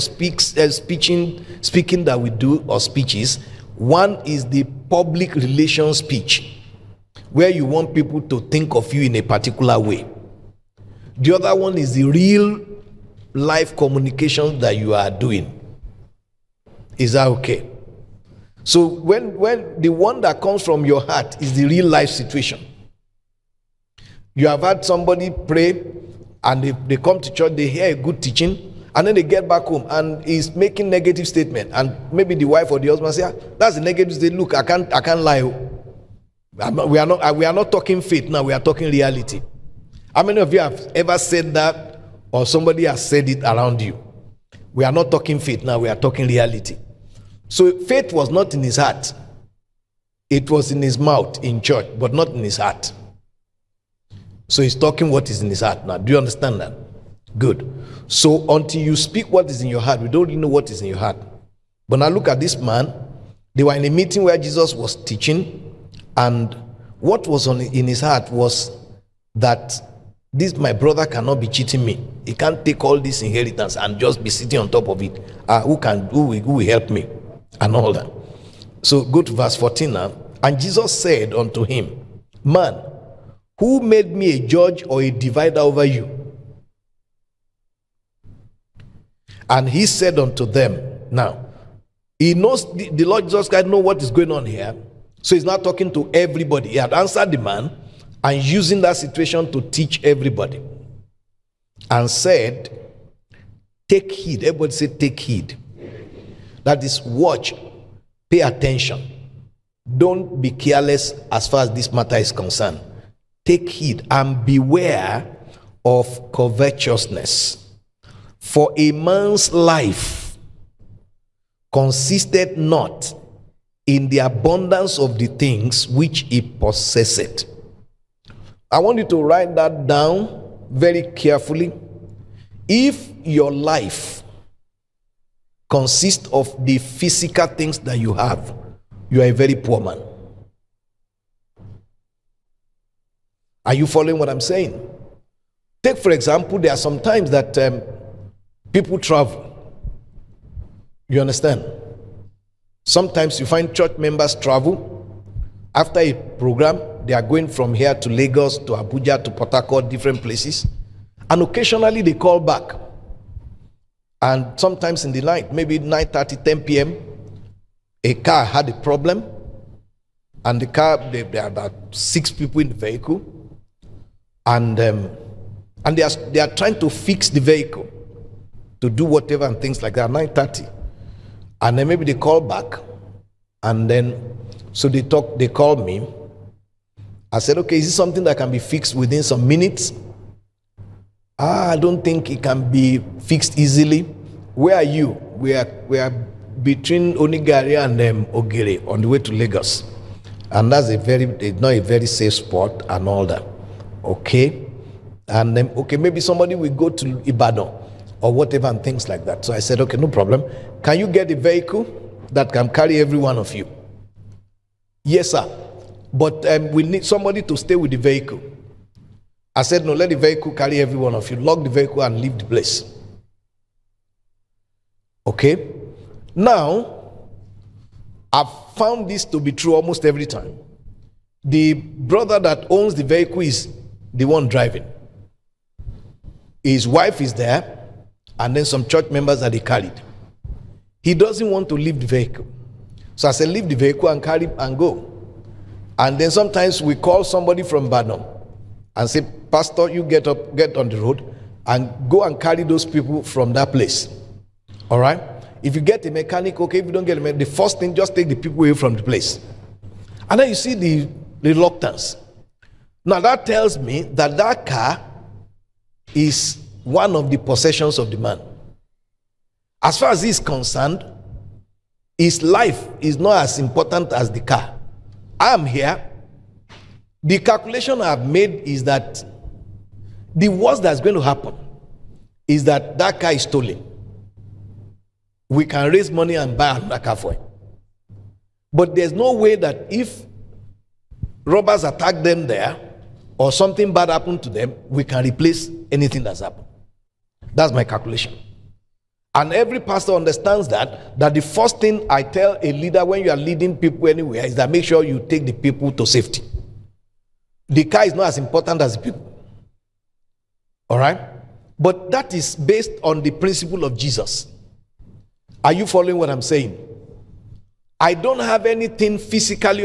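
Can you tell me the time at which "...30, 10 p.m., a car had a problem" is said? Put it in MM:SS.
02:46.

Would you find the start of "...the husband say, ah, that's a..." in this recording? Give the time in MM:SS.
00:32.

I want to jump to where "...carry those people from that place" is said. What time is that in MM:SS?
04:12.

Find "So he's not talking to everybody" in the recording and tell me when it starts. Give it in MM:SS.
01:35.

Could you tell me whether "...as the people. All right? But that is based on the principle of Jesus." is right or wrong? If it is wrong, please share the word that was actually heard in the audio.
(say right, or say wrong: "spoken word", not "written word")
right.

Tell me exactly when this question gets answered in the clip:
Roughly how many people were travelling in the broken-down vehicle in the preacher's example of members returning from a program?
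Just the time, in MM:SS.
02:51.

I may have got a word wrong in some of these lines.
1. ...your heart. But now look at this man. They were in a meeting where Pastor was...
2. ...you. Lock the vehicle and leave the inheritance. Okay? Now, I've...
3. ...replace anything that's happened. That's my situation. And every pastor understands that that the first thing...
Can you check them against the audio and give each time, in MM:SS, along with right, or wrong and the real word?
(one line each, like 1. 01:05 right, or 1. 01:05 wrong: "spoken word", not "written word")
1. 01:00 wrong: "Jesus", not "Pastor"
2. 03:41 wrong: "place", not "inheritance"
3. 04:55 wrong: "calculation", not "situation".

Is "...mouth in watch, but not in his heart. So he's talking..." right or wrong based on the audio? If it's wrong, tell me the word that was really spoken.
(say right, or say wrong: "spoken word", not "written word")
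wrong: "church", not "watch".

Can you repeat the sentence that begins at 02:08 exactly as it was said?
I want you to write that down very carefully.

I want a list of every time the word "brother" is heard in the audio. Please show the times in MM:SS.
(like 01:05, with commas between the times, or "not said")
01:10, 03:51.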